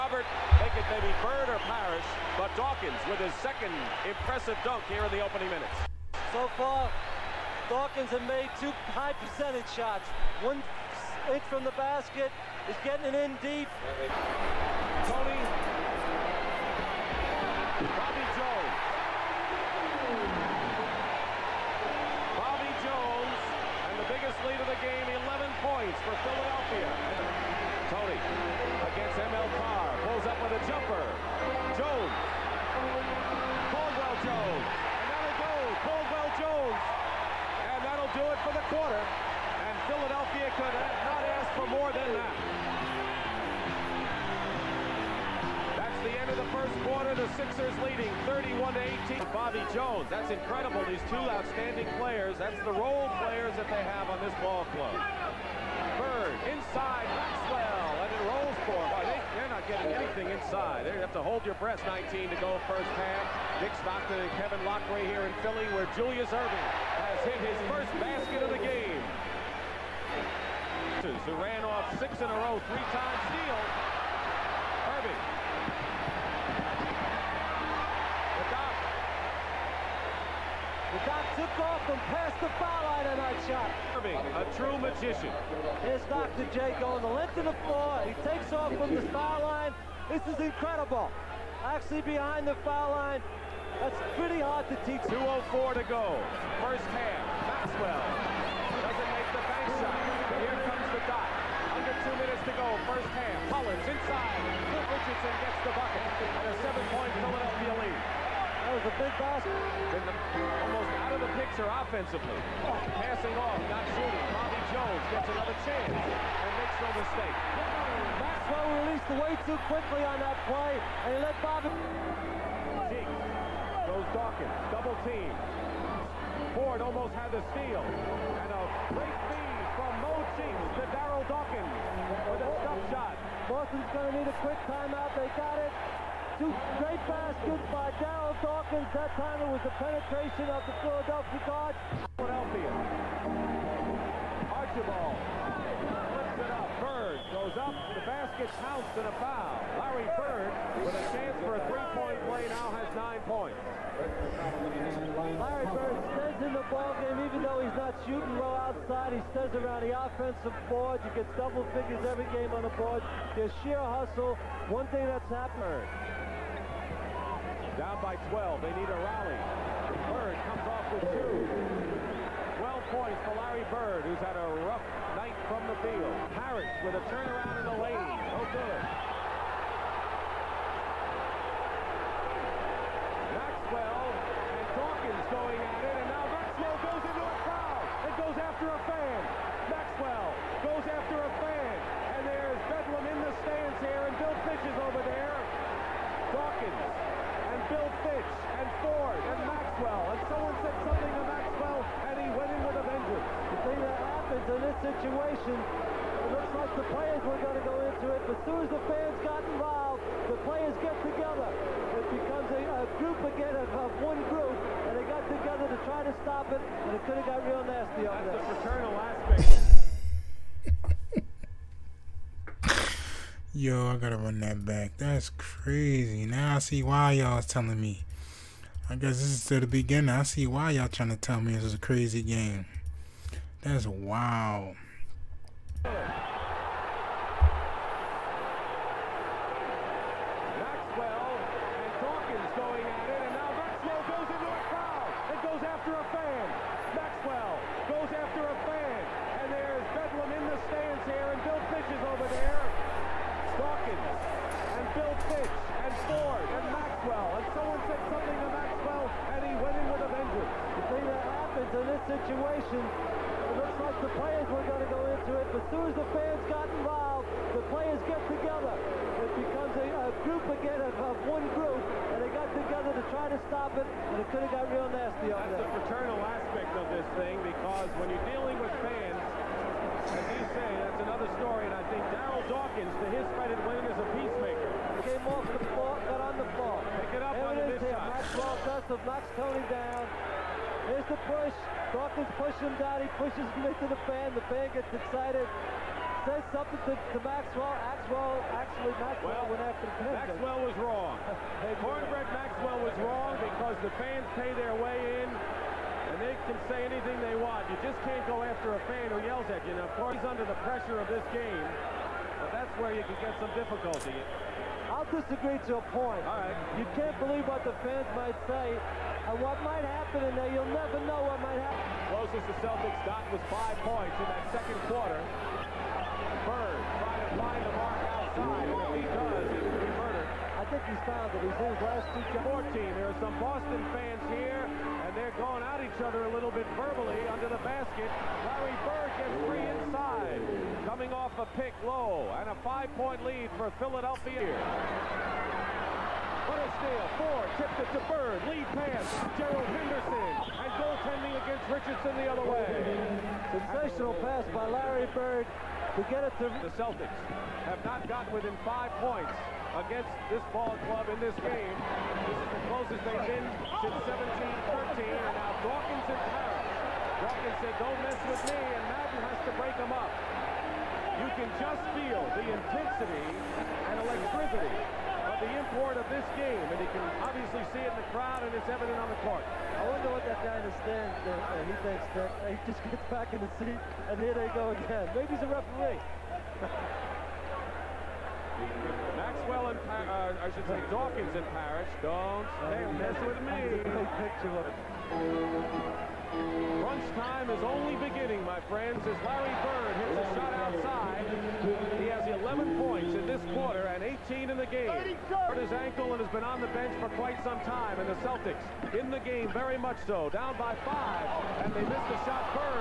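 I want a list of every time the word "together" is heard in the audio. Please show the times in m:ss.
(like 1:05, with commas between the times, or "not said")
3:31, 3:35, 4:28, 4:32.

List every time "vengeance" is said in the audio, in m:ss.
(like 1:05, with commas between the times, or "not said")
3:22, 4:20.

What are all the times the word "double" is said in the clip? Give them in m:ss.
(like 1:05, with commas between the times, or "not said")
2:04, 2:41.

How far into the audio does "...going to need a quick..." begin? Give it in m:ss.
2:13.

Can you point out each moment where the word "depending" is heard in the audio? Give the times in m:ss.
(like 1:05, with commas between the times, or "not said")
not said.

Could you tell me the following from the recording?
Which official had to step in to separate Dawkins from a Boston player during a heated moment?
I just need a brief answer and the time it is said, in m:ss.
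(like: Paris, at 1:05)
Madden, at 6:08.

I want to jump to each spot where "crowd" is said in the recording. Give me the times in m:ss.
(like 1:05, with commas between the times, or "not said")
3:07, 6:18.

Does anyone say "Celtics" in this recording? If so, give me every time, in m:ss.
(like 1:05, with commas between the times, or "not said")
5:22, 5:56, 6:48.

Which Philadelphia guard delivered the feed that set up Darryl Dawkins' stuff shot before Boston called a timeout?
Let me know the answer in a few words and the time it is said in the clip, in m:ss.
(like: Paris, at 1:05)
Mo Cheeks, at 2:10.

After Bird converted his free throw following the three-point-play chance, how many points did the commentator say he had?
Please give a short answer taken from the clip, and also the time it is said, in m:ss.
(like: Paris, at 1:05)
12, at 2:52.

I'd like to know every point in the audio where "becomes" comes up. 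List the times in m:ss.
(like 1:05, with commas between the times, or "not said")
3:32, 4:29.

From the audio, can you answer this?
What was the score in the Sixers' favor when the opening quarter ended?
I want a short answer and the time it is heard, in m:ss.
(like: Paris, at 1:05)
31 to 18, at 0:48.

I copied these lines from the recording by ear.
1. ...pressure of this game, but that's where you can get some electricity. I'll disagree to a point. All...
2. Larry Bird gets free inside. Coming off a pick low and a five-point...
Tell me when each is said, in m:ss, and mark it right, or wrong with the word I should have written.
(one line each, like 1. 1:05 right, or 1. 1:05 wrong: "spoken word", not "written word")
1. 5:10 wrong: "difficulty", not "electricity"
2. 5:38 right.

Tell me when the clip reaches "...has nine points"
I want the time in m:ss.
2:32.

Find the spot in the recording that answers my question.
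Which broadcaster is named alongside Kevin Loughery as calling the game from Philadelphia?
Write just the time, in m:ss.
1:03.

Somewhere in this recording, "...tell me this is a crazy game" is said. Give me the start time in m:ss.
3:51.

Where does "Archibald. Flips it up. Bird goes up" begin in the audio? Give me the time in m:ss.
2:24.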